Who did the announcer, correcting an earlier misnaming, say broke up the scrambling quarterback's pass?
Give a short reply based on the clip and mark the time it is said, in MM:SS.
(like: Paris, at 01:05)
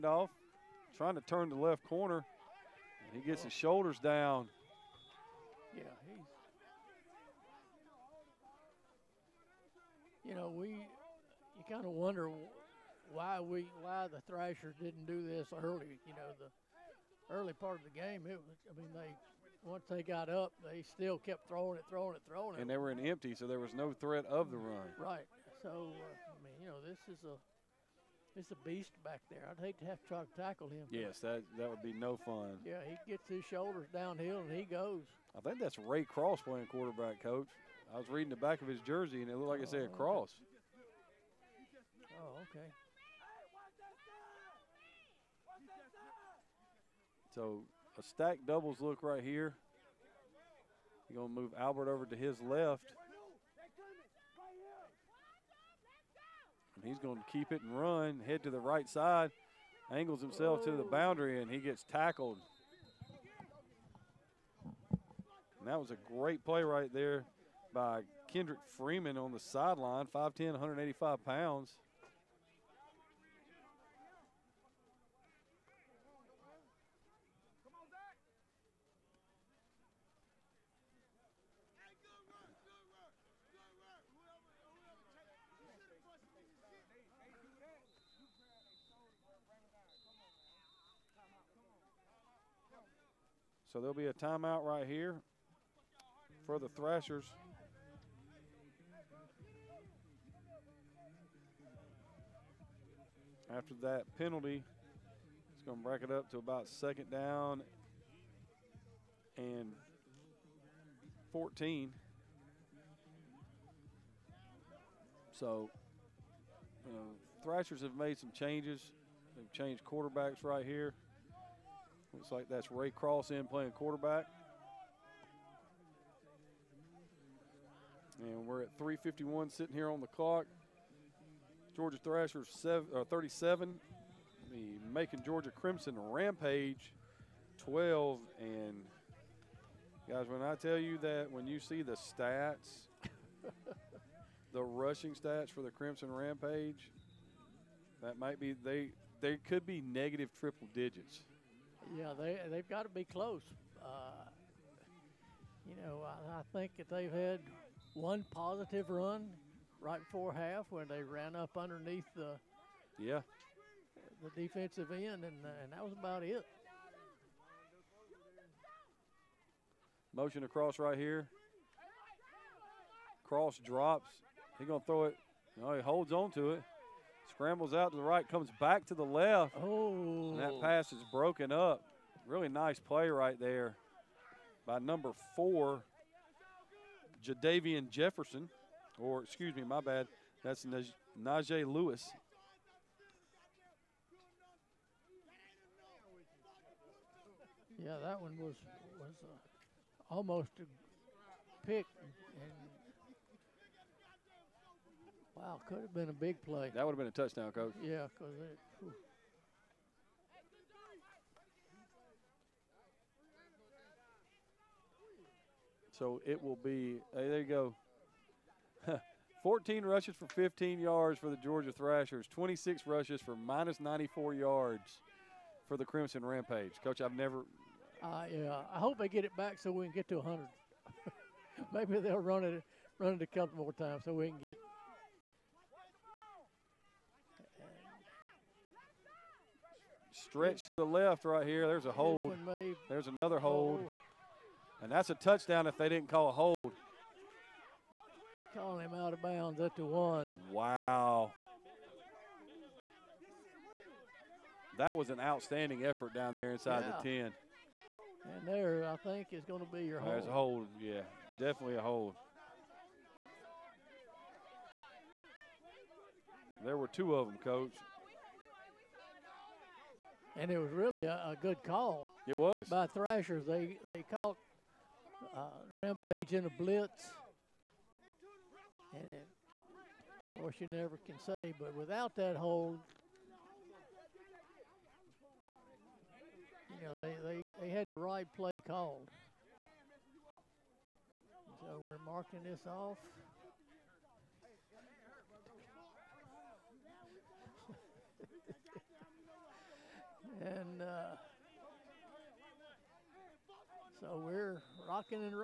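Najee Lewis, at 03:10.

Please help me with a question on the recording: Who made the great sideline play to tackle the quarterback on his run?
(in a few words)
Kendrick Freeman.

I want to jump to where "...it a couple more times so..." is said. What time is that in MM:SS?
03:53.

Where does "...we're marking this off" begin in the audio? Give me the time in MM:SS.
04:51.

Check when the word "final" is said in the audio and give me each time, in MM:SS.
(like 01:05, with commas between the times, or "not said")
not said.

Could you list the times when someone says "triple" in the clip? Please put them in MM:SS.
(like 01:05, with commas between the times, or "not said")
02:30.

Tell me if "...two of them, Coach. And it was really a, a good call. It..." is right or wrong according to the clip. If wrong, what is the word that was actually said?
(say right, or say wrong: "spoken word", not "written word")
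right.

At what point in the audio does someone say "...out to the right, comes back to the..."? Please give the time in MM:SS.
02:57.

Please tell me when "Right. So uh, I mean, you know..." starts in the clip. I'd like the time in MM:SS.
00:24.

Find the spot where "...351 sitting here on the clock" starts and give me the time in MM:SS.
02:08.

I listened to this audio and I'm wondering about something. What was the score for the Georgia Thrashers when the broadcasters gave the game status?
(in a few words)
37.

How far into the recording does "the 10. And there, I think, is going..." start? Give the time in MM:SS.
04:17.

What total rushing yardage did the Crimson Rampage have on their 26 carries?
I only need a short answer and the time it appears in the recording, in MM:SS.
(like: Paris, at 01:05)
-94 yards, at 03:43.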